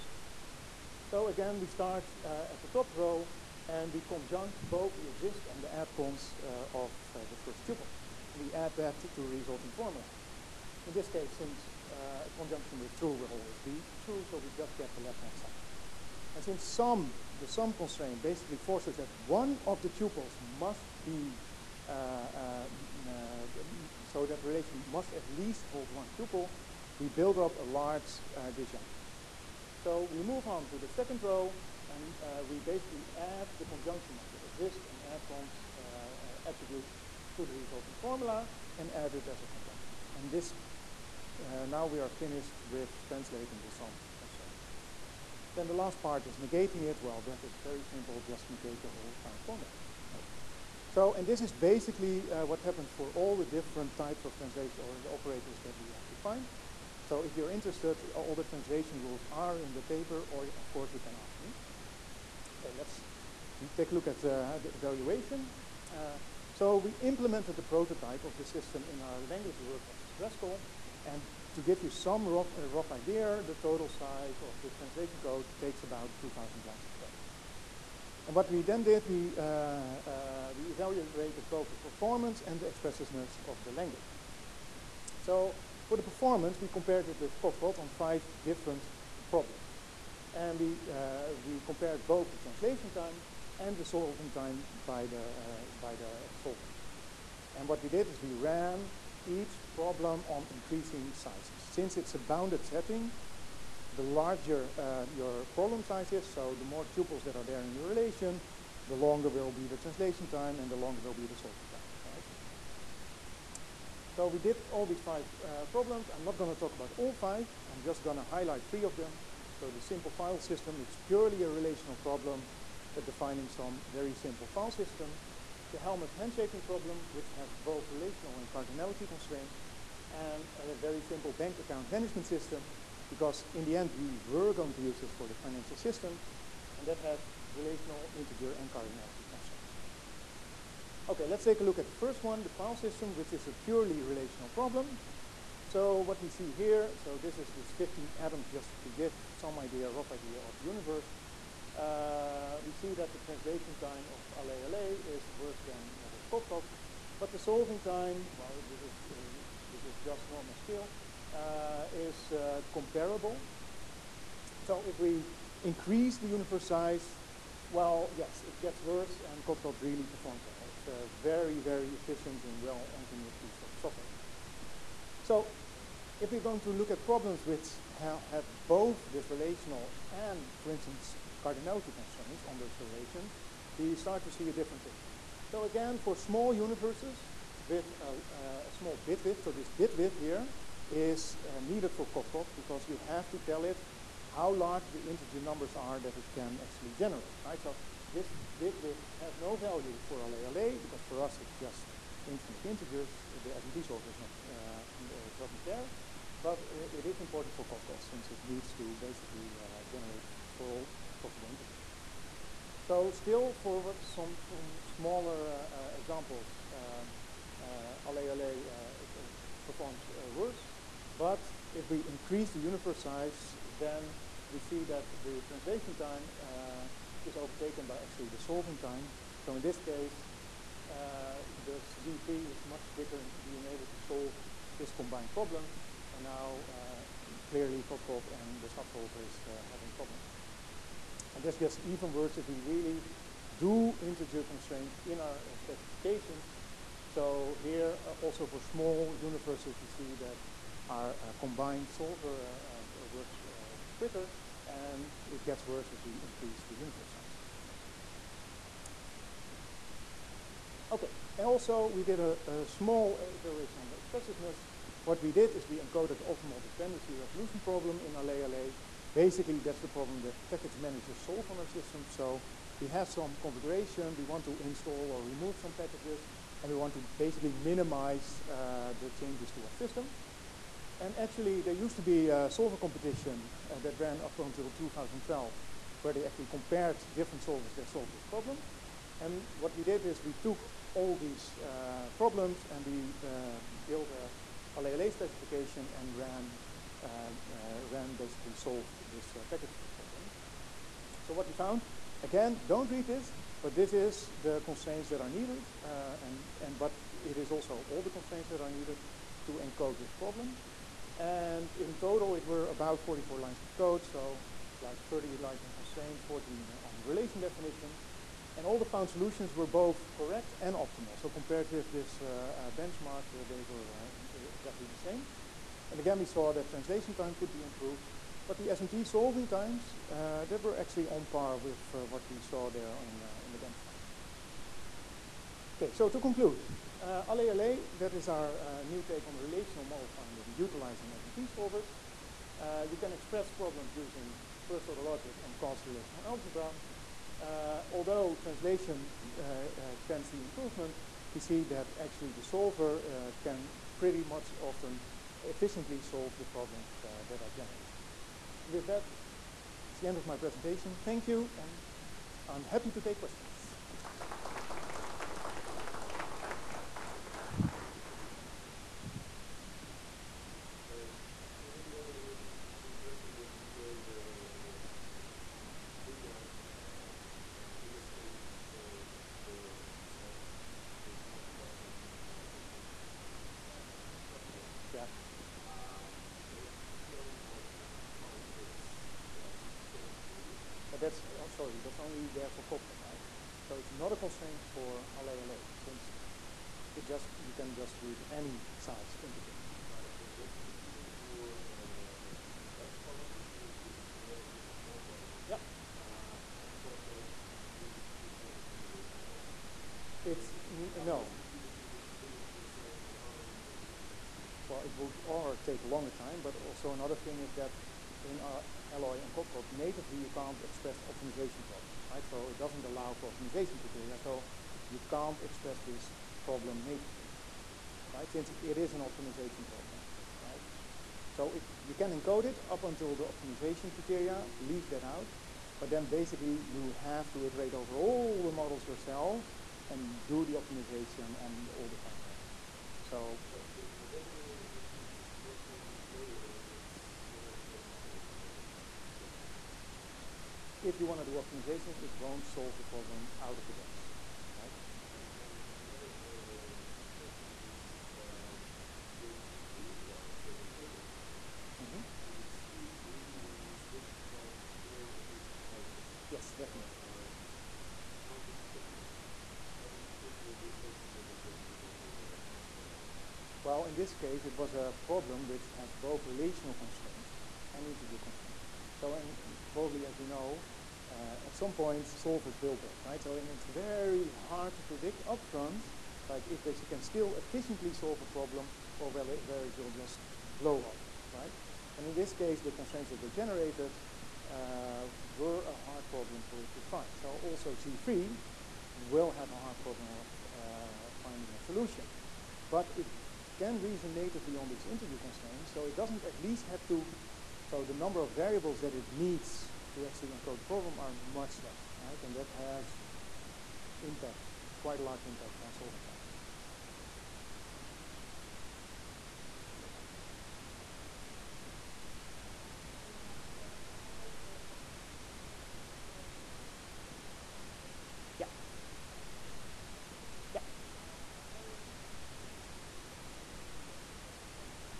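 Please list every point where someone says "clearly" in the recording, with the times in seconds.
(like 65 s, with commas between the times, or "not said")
237 s.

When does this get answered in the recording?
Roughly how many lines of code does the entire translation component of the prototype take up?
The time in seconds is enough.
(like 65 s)
76 s.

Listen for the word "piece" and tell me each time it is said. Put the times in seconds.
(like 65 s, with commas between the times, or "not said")
173 s.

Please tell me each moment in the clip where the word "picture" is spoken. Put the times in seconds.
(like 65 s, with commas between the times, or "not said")
184 s.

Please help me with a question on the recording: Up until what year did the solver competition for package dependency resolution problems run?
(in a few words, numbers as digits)
2012.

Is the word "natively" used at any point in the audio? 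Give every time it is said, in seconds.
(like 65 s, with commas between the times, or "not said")
419 s, 426 s, 504 s.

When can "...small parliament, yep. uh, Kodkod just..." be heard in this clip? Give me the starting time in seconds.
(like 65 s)
404 s.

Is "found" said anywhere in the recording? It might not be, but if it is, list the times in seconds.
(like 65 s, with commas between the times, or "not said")
49 s, 301 s, 318 s, 441 s.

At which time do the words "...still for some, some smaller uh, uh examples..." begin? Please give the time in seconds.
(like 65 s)
213 s.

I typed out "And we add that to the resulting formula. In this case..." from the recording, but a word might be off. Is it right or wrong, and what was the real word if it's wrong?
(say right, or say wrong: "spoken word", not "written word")
right.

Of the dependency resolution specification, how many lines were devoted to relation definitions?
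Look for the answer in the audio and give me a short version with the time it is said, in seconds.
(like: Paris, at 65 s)
14, at 316 s.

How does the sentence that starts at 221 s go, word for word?
But if we increase the universe size, then we see that the translation time uh, is overtaken by actually the solving time.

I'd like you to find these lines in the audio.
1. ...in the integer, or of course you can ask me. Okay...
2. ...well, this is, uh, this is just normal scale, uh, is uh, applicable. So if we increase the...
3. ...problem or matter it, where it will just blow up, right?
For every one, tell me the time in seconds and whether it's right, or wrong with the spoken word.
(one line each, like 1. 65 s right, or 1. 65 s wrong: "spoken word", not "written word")
1. 59 s wrong: "paper", not "integer"
2. 158 s wrong: "comparable", not "applicable"
3. 488 s wrong: "whether", not "matter".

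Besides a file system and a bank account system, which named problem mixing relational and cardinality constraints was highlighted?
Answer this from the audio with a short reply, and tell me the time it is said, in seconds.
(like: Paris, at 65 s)
Halmos handshaking problem, at 125 s.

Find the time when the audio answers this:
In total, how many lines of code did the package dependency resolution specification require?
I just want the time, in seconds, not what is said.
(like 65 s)
313 s.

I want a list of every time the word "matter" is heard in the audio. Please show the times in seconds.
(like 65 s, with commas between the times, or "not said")
471 s.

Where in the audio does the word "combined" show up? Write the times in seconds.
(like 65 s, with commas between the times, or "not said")
234 s, 251 s.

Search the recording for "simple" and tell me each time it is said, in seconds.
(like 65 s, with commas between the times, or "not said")
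47 s, 119 s, 124 s, 131 s.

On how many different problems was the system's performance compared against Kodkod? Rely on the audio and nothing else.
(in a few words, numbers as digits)
5.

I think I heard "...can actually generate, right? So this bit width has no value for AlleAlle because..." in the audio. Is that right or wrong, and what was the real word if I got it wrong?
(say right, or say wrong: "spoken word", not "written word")
right.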